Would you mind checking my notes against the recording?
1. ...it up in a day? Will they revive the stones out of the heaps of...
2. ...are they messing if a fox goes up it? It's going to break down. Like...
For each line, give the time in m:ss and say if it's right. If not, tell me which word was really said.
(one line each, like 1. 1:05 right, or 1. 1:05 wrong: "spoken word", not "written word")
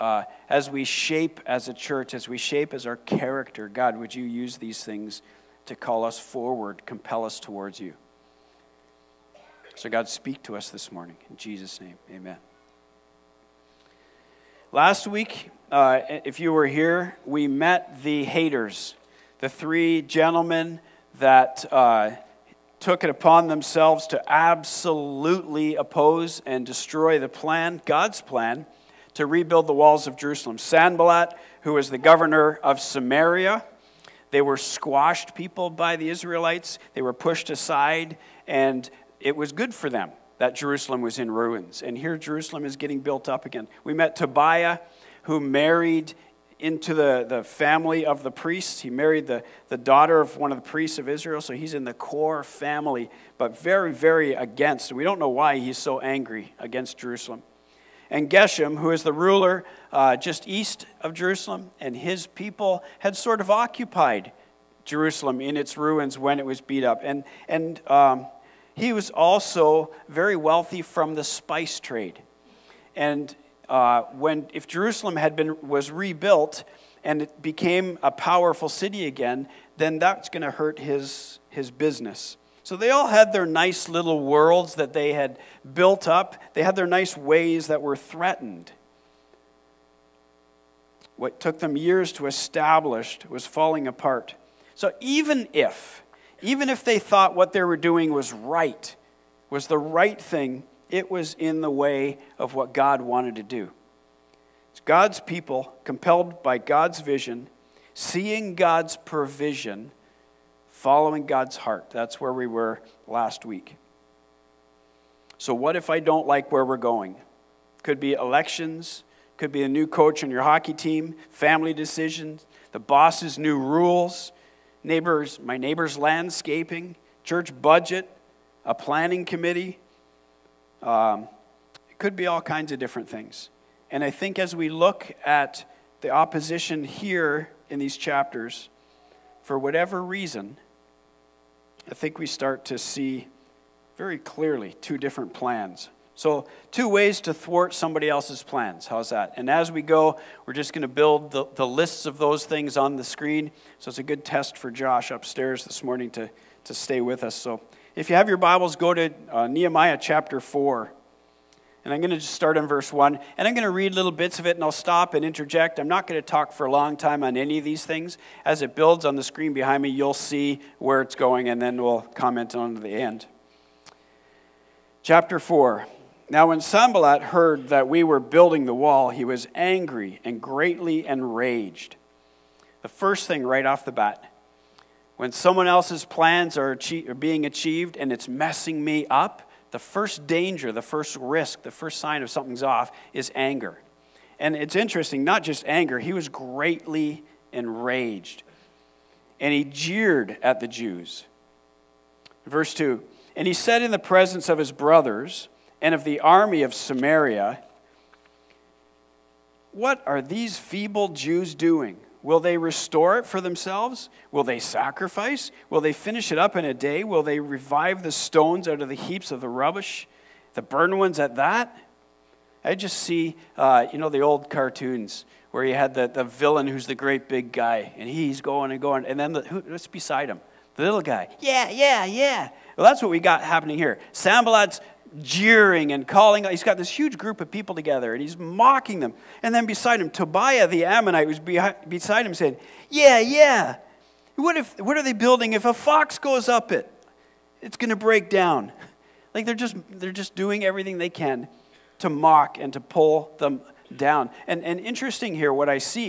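1. 3:36 right
2. 4:04 wrong: "building", not "messing".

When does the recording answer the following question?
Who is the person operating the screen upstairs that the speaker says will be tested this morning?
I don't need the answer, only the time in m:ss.
2:34.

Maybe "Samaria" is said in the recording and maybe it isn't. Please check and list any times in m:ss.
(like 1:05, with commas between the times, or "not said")
0:32, 3:26.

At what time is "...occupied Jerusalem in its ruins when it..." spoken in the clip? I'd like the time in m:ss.
1:03.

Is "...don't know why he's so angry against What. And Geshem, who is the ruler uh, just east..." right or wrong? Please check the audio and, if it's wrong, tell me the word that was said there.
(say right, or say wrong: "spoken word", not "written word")
wrong: "Jerusalem", not "What".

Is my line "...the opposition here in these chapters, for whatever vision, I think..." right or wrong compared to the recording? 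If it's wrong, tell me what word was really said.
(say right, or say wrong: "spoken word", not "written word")
wrong: "reason", not "vision".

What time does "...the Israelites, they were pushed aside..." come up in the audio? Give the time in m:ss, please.
0:35.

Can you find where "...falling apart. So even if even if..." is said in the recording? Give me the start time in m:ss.
1:33.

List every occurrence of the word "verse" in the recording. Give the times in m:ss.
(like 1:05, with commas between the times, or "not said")
2:42, 3:22.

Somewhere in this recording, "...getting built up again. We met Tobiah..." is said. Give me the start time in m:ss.
0:42.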